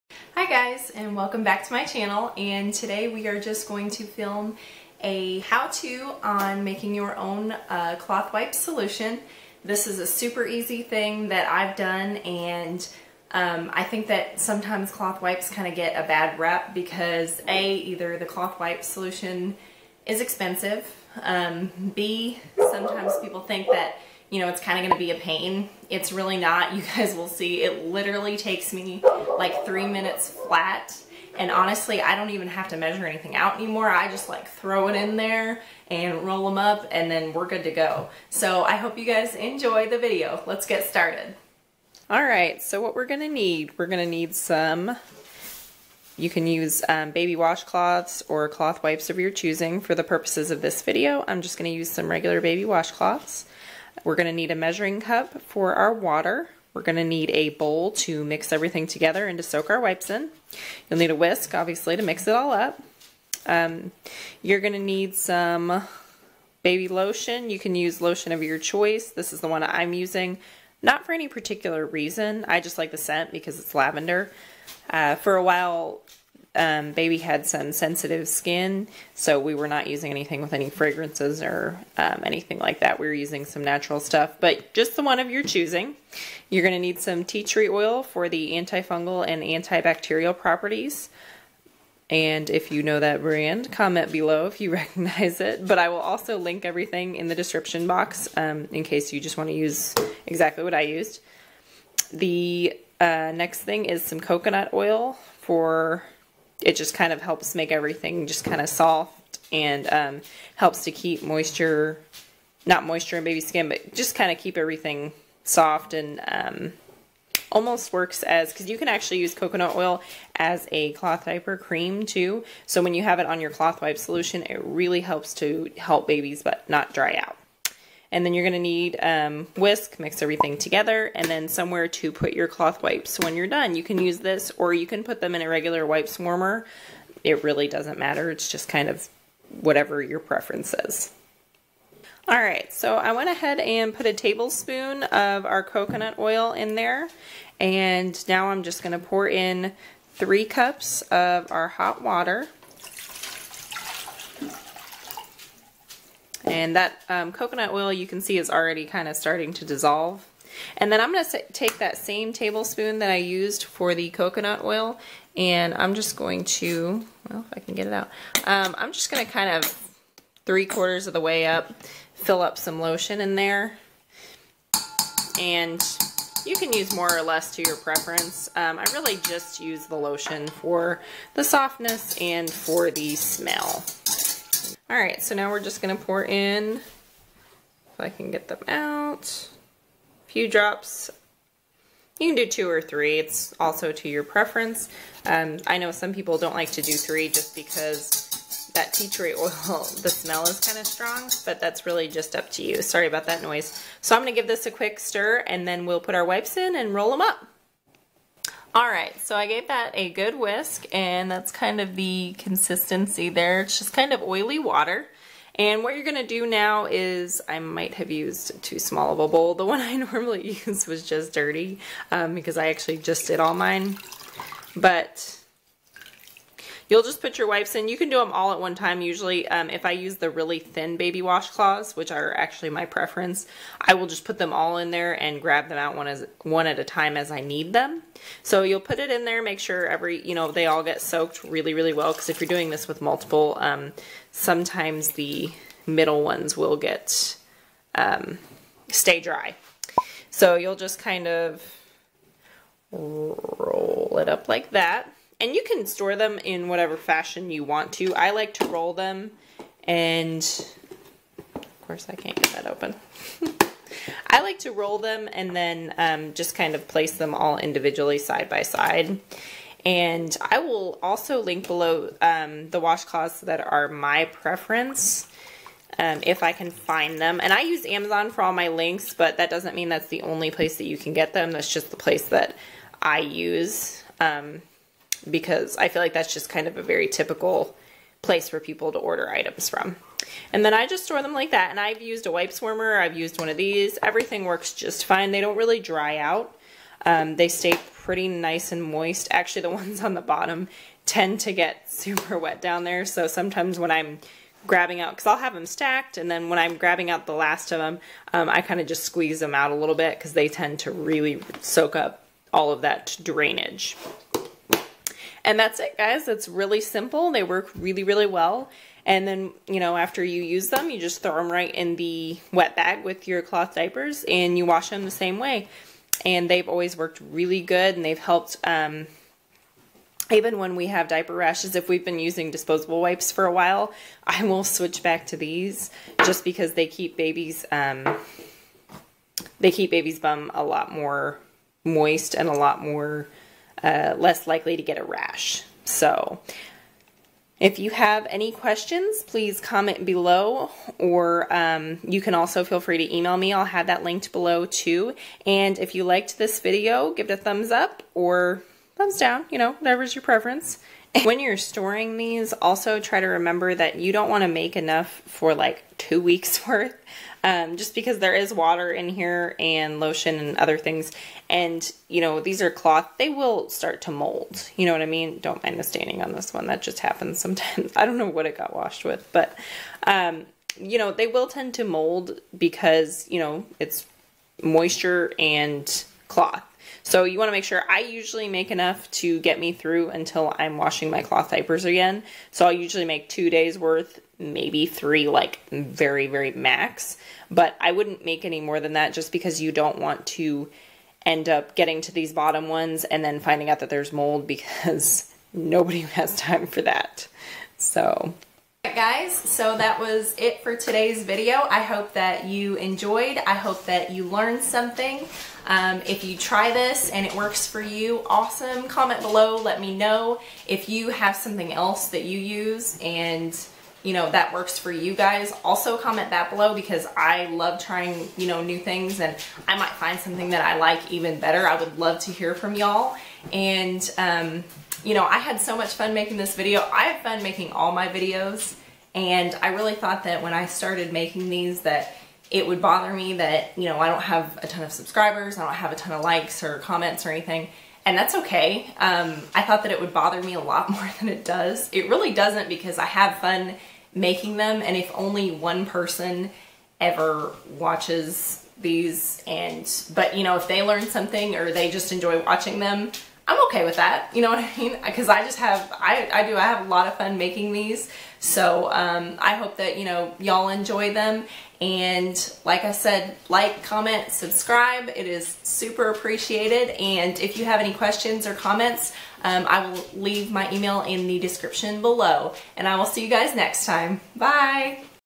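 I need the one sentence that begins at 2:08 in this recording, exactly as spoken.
And then you're gonna need um, whisk, mix everything together, and then somewhere to put your cloth wipes.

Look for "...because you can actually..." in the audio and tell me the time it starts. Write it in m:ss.
1:58.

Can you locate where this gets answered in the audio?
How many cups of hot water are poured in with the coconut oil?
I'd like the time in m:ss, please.
2:30.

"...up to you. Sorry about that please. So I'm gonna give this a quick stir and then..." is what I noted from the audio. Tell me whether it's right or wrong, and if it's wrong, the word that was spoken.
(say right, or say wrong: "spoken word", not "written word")
wrong: "noise", not "please".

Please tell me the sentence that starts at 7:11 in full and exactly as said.
I would love to hear from y'all.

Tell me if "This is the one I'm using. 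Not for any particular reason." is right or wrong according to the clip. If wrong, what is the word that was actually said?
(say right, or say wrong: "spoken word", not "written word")
right.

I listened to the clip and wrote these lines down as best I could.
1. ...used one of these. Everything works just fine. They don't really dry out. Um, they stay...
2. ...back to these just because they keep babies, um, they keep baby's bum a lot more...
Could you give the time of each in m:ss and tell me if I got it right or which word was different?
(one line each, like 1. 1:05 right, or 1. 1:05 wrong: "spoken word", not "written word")
1. 4:53 right
2. 5:35 right.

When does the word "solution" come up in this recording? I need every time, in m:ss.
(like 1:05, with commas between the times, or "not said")
0:08, 0:18, 2:03.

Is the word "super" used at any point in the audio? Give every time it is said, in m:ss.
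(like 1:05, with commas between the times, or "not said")
0:10, 5:01, 7:55.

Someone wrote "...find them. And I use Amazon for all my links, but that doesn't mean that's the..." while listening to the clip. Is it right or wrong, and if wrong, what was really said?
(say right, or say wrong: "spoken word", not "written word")
right.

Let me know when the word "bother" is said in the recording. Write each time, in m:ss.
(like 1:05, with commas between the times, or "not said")
7:22, 7:30.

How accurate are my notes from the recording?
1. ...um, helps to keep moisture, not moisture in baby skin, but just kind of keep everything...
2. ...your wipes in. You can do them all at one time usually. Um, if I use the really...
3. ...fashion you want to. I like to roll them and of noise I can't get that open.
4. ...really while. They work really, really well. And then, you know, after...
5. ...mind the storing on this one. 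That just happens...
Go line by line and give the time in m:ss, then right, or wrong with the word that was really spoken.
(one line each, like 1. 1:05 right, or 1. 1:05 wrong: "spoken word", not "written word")
1. 1:49 right
2. 3:47 right
3. 4:16 wrong: "course", not "noise"
4. 5:16 wrong: "simple", not "while"
5. 6:15 wrong: "staining", not "storing".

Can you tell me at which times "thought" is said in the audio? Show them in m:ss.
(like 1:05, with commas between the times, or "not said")
7:19, 7:29.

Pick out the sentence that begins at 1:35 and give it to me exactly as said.
But I will also link everything in the description box um, in case you just want to use exactly what I used.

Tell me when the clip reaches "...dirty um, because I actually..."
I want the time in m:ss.
3:41.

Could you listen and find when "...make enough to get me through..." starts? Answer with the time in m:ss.
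6:28.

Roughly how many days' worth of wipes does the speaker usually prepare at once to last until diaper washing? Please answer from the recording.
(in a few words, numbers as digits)
2.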